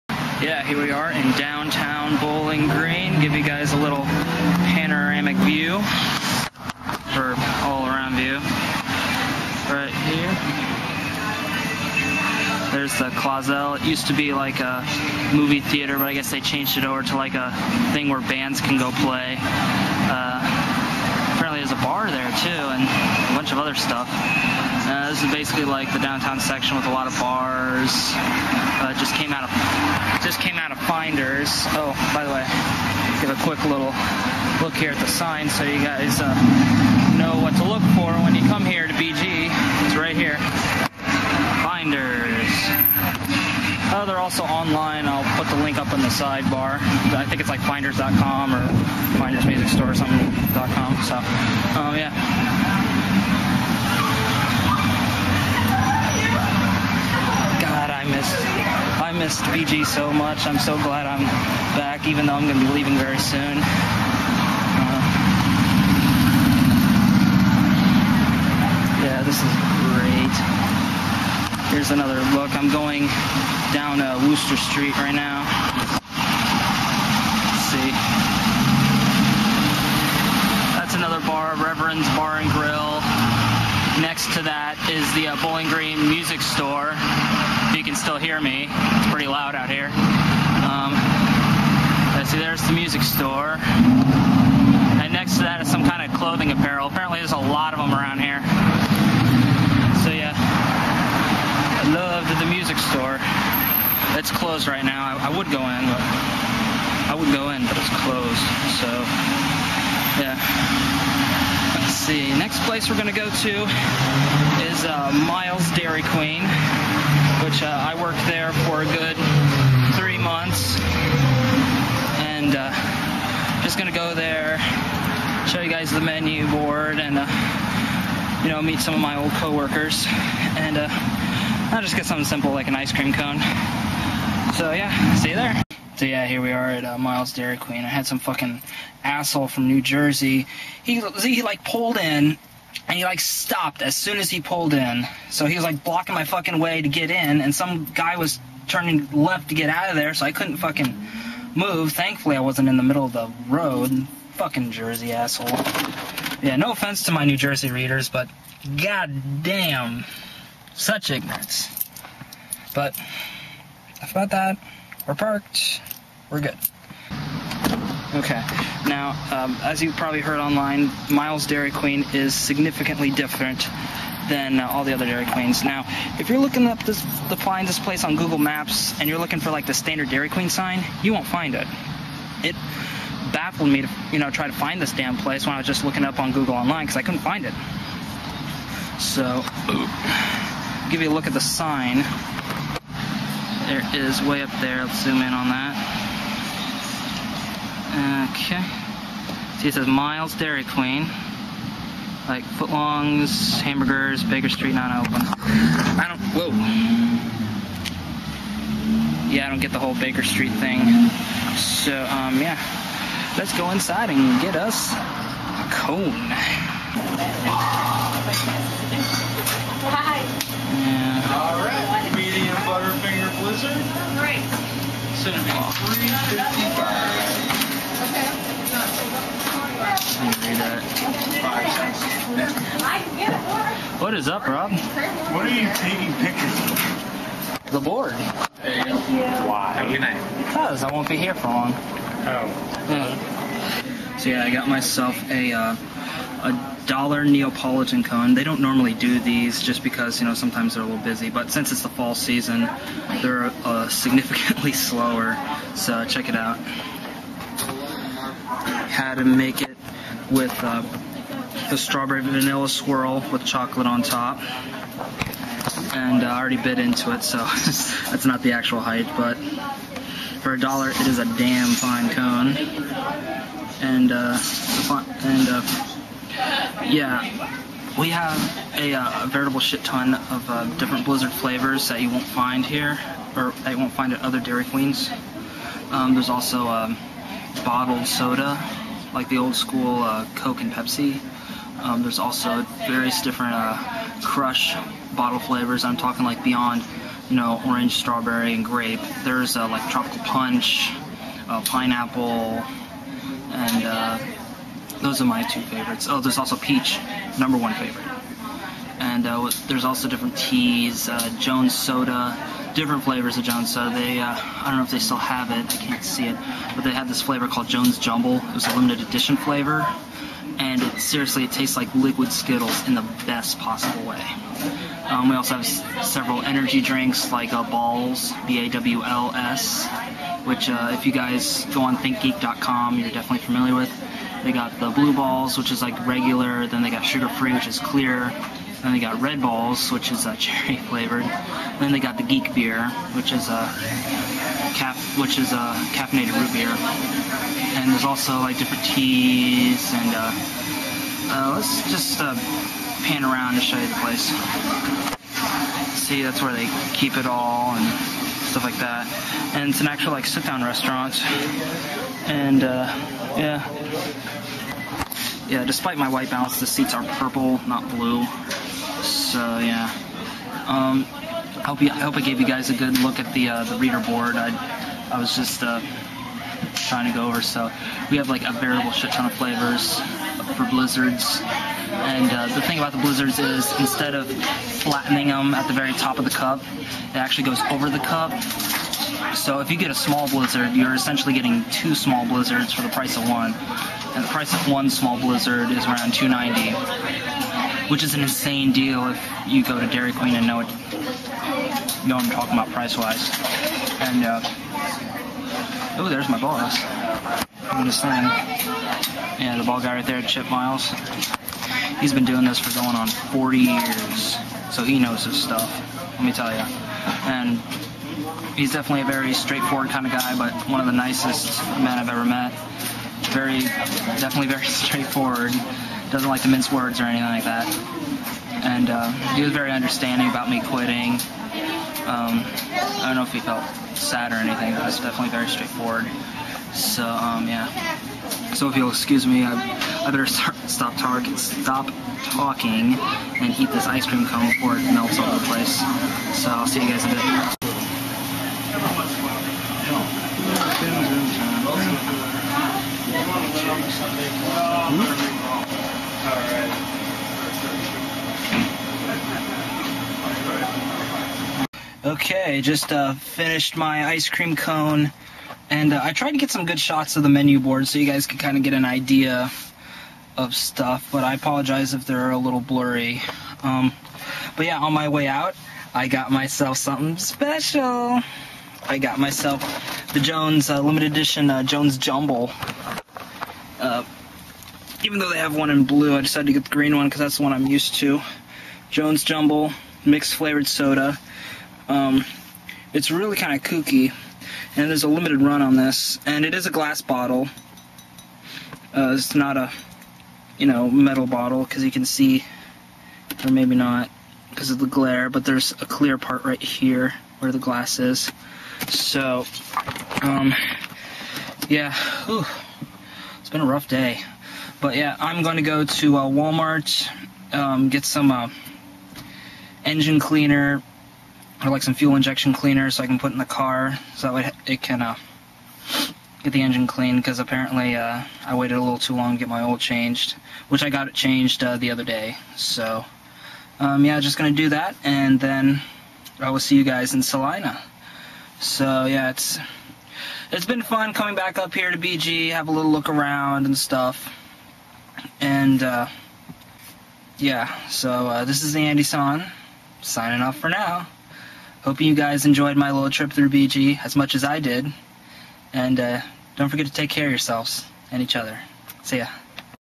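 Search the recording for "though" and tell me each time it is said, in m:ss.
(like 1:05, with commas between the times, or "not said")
1:02, 8:05.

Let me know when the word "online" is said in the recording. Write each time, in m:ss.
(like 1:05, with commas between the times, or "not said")
0:44, 2:50, 3:06.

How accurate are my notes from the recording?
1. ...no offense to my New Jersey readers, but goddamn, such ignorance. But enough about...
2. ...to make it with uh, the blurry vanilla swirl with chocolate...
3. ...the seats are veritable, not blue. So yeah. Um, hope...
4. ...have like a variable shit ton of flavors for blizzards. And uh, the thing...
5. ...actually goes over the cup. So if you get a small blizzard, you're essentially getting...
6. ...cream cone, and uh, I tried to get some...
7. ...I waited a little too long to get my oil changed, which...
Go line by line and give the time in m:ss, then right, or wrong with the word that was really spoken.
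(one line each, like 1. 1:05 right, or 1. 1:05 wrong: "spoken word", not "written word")
1. 2:36 right
2. 4:19 wrong: "strawberry", not "blurry"
3. 6:06 wrong: "purple", not "veritable"
4. 6:18 right
5. 6:27 right
6. 7:44 right
7. 8:48 right.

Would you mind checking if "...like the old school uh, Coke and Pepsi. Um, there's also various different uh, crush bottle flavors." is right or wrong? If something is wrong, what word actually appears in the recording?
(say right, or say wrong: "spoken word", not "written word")
right.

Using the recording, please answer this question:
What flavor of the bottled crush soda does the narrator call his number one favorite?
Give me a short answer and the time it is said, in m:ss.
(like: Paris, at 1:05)
Peach, at 5:06.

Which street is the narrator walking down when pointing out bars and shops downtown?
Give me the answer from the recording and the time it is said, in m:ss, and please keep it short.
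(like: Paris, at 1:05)
Wooster Street, at 1:14.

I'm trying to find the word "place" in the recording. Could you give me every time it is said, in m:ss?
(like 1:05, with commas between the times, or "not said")
1:52, 2:57, 3:05, 5:54, 7:25.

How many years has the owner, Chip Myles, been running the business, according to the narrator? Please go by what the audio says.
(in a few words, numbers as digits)
40 years.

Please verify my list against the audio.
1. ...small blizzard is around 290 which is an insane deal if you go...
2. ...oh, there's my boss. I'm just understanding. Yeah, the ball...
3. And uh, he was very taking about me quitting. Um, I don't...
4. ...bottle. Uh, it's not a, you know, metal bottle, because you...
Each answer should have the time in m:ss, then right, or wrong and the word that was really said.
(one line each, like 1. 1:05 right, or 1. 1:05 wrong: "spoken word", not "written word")
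1. 6:34 right
2. 6:46 wrong: "saying", not "understanding"
3. 7:08 wrong: "understanding", not "taking"
4. 8:17 right.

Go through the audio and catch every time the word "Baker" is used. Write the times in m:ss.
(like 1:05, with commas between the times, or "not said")
3:24, 3:29.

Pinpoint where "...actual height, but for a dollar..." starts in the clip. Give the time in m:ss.
4:28.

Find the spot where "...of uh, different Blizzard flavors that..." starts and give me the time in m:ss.
4:40.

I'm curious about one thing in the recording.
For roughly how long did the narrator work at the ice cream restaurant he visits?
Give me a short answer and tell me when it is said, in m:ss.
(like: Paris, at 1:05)
3 months, at 1:59.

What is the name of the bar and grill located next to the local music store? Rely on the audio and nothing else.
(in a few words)
Reverend's Bar and Grill.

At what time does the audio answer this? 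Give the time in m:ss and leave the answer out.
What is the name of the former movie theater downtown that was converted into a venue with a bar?
0:13.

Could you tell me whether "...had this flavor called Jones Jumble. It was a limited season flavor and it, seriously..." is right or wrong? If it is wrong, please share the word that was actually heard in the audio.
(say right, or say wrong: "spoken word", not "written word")
wrong: "edition", not "season".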